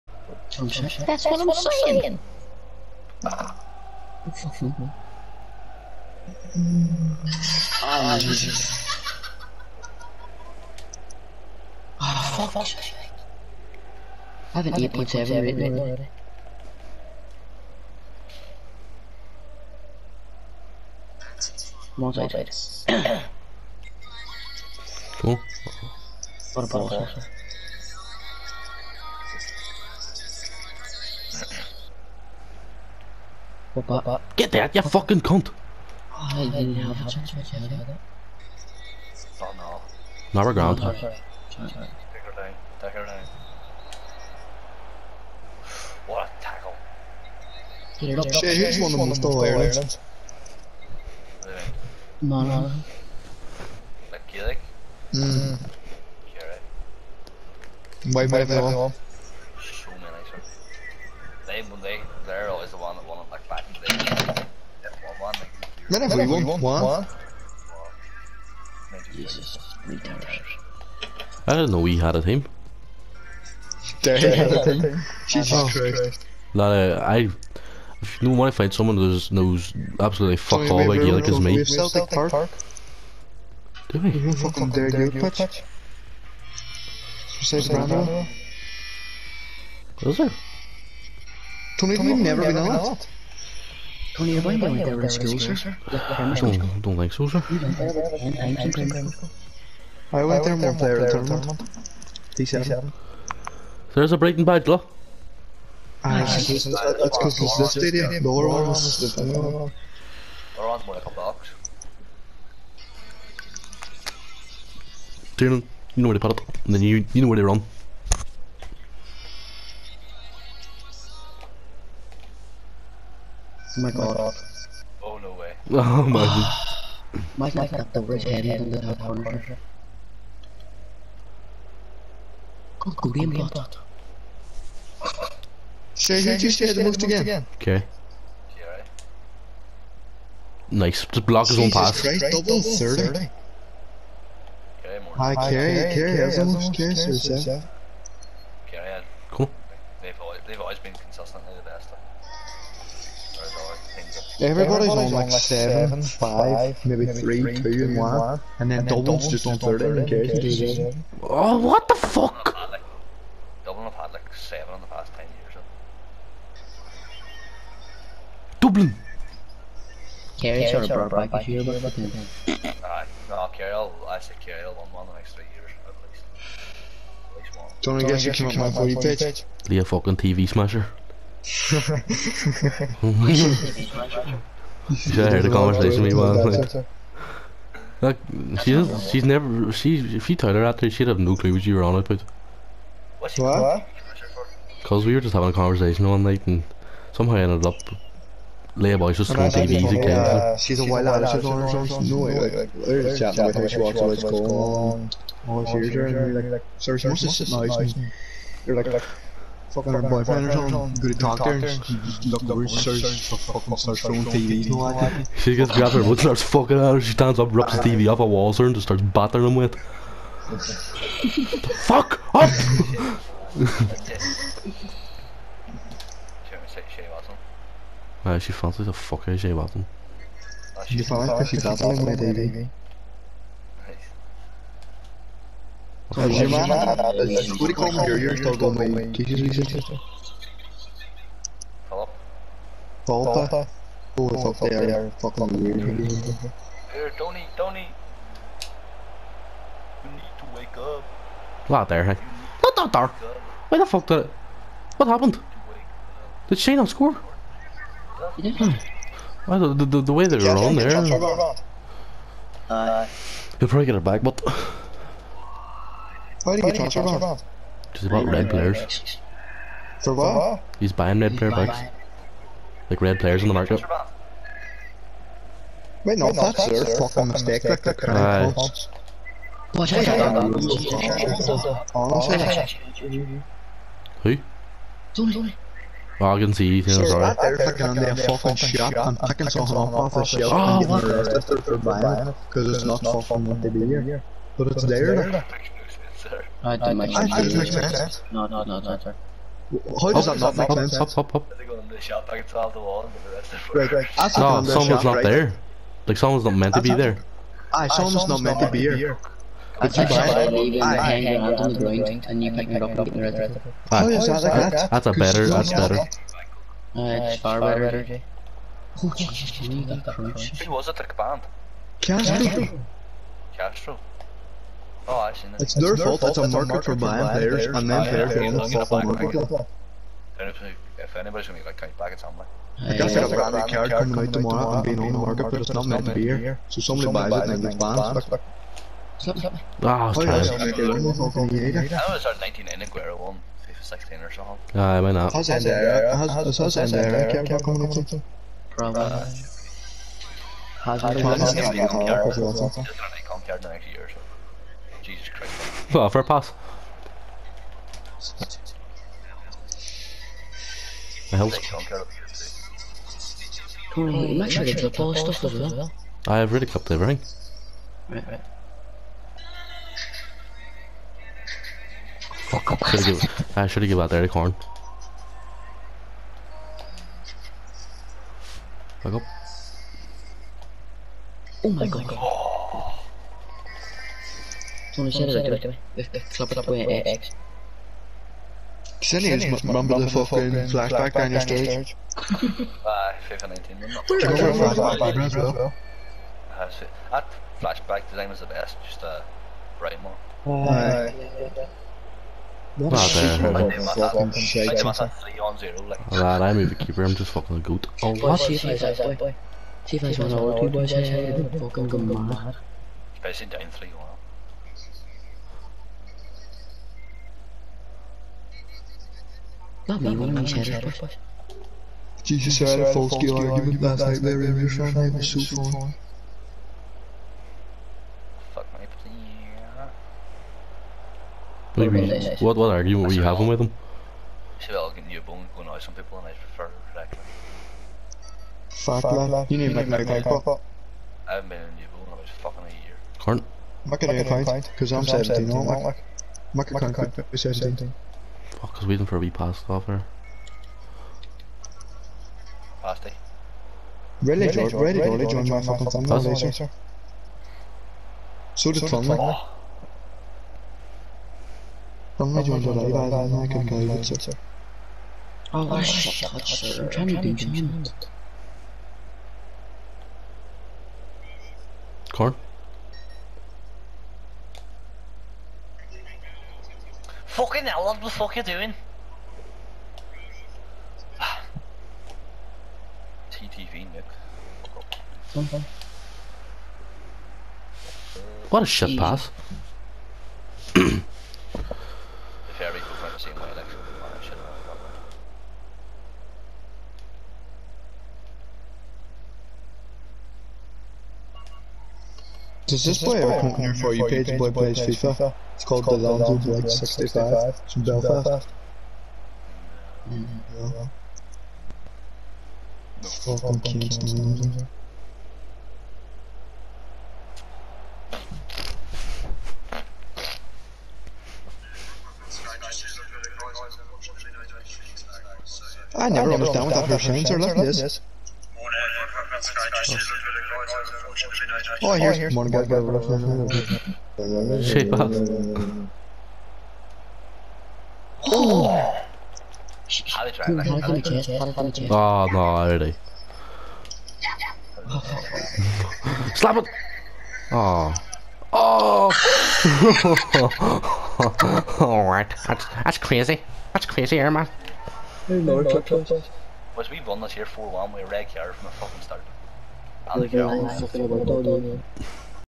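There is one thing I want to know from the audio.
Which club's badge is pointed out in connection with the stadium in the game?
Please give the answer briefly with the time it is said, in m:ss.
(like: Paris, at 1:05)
Brighton, at 1:44.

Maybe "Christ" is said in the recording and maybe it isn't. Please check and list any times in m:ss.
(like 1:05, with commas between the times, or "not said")
1:15, 2:22, 5:55.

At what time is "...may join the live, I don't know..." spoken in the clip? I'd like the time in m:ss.
7:42.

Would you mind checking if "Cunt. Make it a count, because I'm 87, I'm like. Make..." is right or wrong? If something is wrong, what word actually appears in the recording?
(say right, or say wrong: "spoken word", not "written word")
wrong: "17", not "87".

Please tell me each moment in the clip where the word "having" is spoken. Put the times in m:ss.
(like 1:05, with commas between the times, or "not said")
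3:15, 7:13.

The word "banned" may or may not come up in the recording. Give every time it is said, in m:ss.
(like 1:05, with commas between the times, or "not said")
5:21, 5:37.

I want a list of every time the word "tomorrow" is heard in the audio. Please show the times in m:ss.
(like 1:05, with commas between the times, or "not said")
5:34.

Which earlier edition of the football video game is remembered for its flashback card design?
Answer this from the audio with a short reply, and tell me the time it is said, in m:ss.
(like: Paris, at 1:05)
FIFA 19, at 6:33.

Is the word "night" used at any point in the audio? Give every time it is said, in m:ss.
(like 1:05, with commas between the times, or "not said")
3:06, 3:16, 7:04.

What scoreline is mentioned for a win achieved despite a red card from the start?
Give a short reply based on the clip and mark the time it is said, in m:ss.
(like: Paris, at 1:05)
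4-1, at 9:17.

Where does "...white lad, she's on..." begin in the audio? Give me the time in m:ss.
3:20.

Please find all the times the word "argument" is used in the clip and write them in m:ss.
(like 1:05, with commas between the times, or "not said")
7:03, 7:12.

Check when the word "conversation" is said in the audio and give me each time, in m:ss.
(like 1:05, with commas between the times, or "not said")
3:05, 3:15.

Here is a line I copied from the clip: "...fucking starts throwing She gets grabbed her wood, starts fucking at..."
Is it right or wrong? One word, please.
right.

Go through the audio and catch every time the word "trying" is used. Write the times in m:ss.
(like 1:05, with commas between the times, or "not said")
5:40, 7:46.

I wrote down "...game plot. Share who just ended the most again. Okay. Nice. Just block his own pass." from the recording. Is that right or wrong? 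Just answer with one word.
wrong.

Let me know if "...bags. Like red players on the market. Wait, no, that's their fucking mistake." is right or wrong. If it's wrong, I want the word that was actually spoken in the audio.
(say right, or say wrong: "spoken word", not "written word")
right.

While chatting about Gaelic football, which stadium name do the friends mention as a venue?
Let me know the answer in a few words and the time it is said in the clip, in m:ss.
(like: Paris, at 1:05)
Celtic Park, at 1:21.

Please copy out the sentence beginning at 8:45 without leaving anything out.
I never, understand what that percent are like this.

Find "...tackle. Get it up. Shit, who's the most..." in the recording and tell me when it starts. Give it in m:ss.
0:46.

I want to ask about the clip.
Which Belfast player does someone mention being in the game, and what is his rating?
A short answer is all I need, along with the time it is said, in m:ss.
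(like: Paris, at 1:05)
Lonzo Blake 65, at 8:25.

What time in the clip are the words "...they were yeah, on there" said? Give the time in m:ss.
4:20.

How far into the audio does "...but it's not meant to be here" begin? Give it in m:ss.
5:35.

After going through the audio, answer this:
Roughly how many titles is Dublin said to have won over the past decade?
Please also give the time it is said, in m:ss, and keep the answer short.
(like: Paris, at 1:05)
7, at 2:44.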